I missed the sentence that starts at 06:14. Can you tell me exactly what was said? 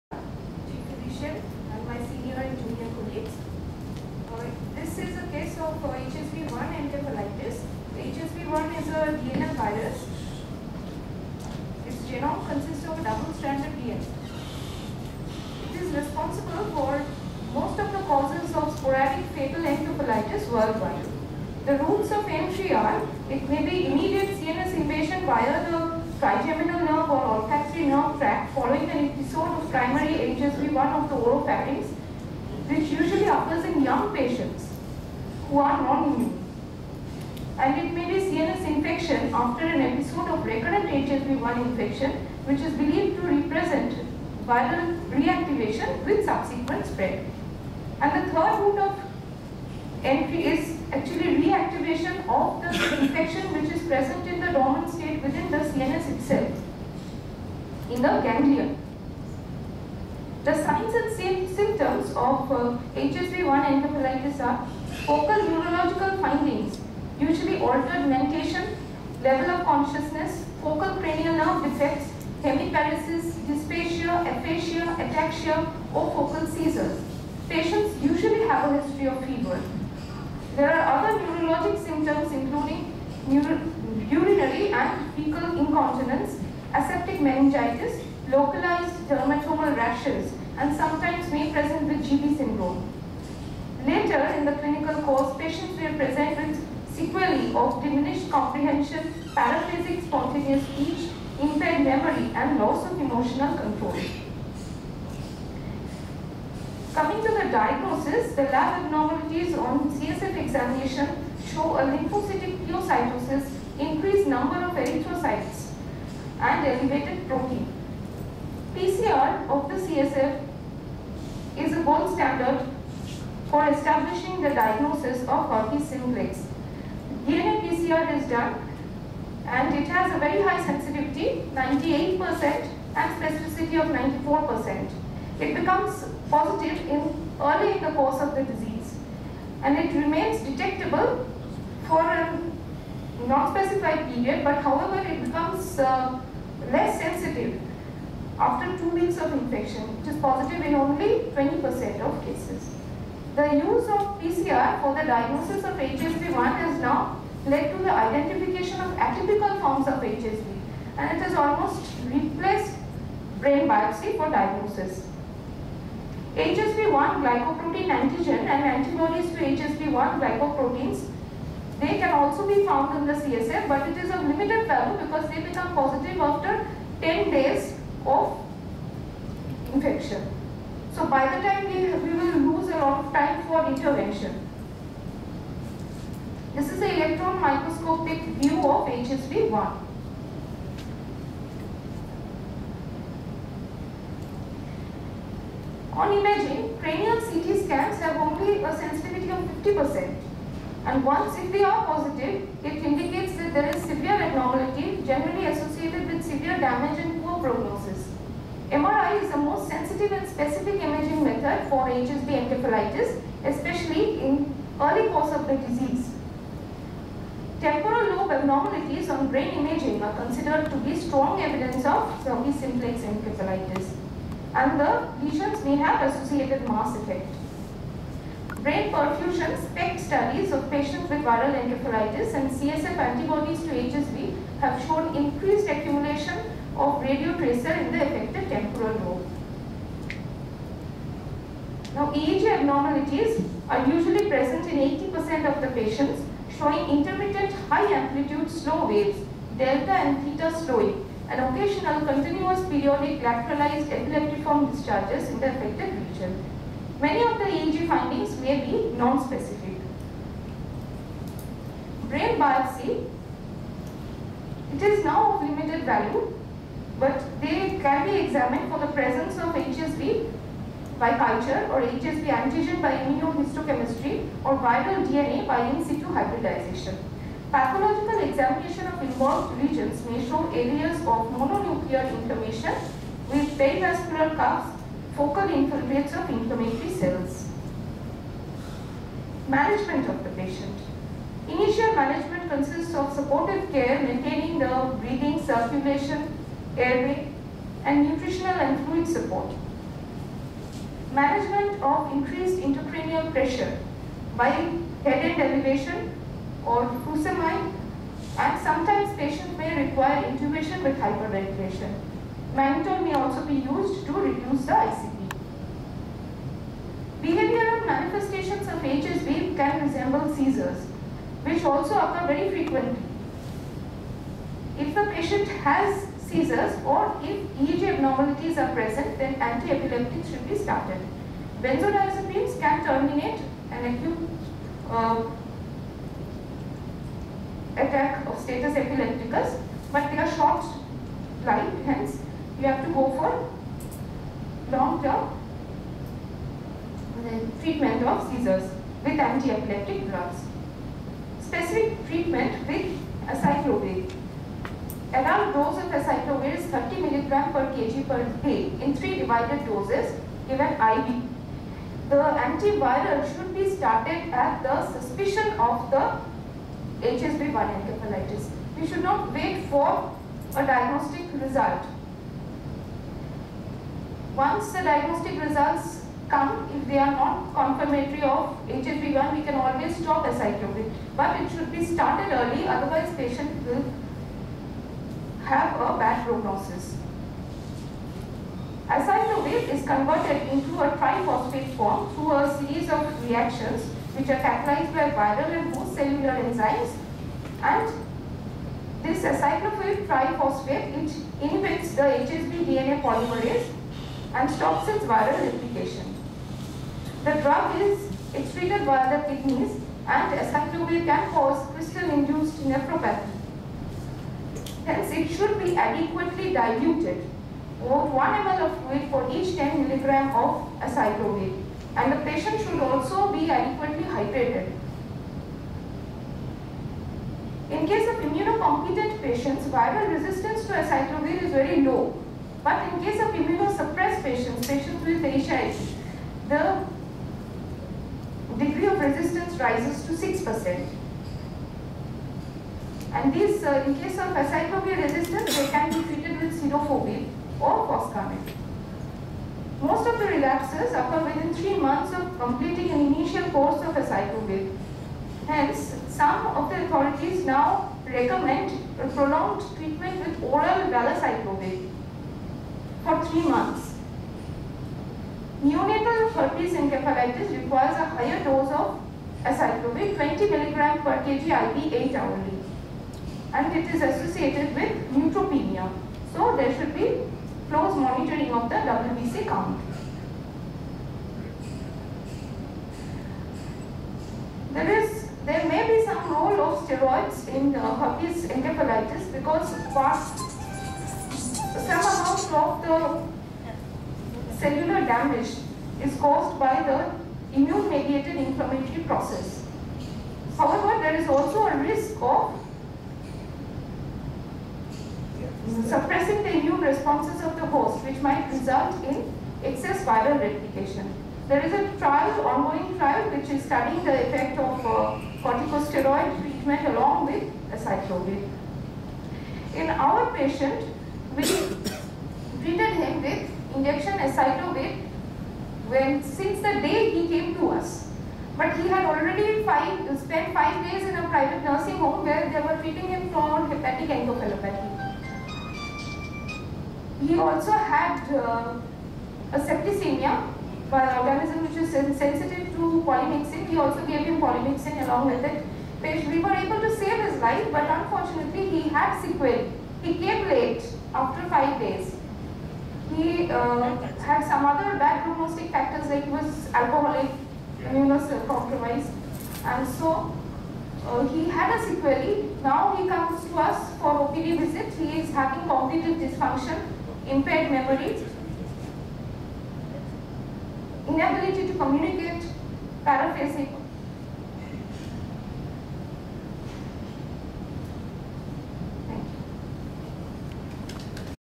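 Once the diagnostic results come if they are not confirmatory of HSV1, we can always stop acyclovir.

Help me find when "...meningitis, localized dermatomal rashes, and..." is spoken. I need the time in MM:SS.
01:27.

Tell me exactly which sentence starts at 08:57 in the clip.
He also had uh, a septicemia, an uh, organism which is sensitive to polymyxin.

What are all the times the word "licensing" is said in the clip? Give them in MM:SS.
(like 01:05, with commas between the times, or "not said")
not said.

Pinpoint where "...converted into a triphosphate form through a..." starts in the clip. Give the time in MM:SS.
06:29.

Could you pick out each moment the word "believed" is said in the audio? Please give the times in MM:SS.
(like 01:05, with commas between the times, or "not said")
00:42.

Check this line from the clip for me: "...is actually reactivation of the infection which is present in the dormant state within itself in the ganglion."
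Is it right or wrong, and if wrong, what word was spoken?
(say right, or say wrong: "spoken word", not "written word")
right.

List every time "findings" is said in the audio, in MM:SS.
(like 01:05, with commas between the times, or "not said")
01:06, 04:17.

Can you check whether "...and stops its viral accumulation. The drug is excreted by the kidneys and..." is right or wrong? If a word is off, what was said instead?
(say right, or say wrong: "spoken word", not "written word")
wrong: "replication", not "accumulation".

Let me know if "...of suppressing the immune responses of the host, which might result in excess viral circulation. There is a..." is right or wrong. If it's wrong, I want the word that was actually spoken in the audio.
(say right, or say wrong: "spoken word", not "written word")
wrong: "replication", not "circulation".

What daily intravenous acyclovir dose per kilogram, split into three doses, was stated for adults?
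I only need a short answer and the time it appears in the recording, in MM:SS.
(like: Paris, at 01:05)
30 mg per kg per day, at 05:56.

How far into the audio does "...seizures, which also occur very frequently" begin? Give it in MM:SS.
05:20.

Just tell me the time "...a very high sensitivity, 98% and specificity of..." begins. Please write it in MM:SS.
02:10.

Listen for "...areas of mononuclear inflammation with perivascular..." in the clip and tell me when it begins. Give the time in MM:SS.
04:40.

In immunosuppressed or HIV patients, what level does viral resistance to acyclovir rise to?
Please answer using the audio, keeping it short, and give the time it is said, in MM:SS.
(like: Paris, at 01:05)
6%, at 07:20.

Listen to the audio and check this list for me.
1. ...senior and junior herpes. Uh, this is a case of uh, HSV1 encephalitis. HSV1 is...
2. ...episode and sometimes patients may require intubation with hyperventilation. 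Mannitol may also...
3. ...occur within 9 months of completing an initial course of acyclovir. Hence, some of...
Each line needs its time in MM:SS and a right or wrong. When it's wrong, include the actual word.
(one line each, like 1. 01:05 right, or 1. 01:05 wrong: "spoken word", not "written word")
1. 00:02 wrong: "colleagues", not "herpes"
2. 05:07 wrong: "furosemide", not "episode"
3. 07:30 wrong: "3", not "9".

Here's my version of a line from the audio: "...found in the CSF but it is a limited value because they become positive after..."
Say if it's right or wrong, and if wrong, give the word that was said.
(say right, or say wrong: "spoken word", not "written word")
right.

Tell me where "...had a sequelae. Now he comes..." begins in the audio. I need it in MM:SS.
09:21.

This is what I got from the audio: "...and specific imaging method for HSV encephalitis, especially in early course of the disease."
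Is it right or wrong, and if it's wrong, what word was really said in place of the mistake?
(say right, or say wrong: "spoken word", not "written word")
right.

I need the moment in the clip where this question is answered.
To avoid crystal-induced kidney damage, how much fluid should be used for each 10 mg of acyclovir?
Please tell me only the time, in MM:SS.
06:58.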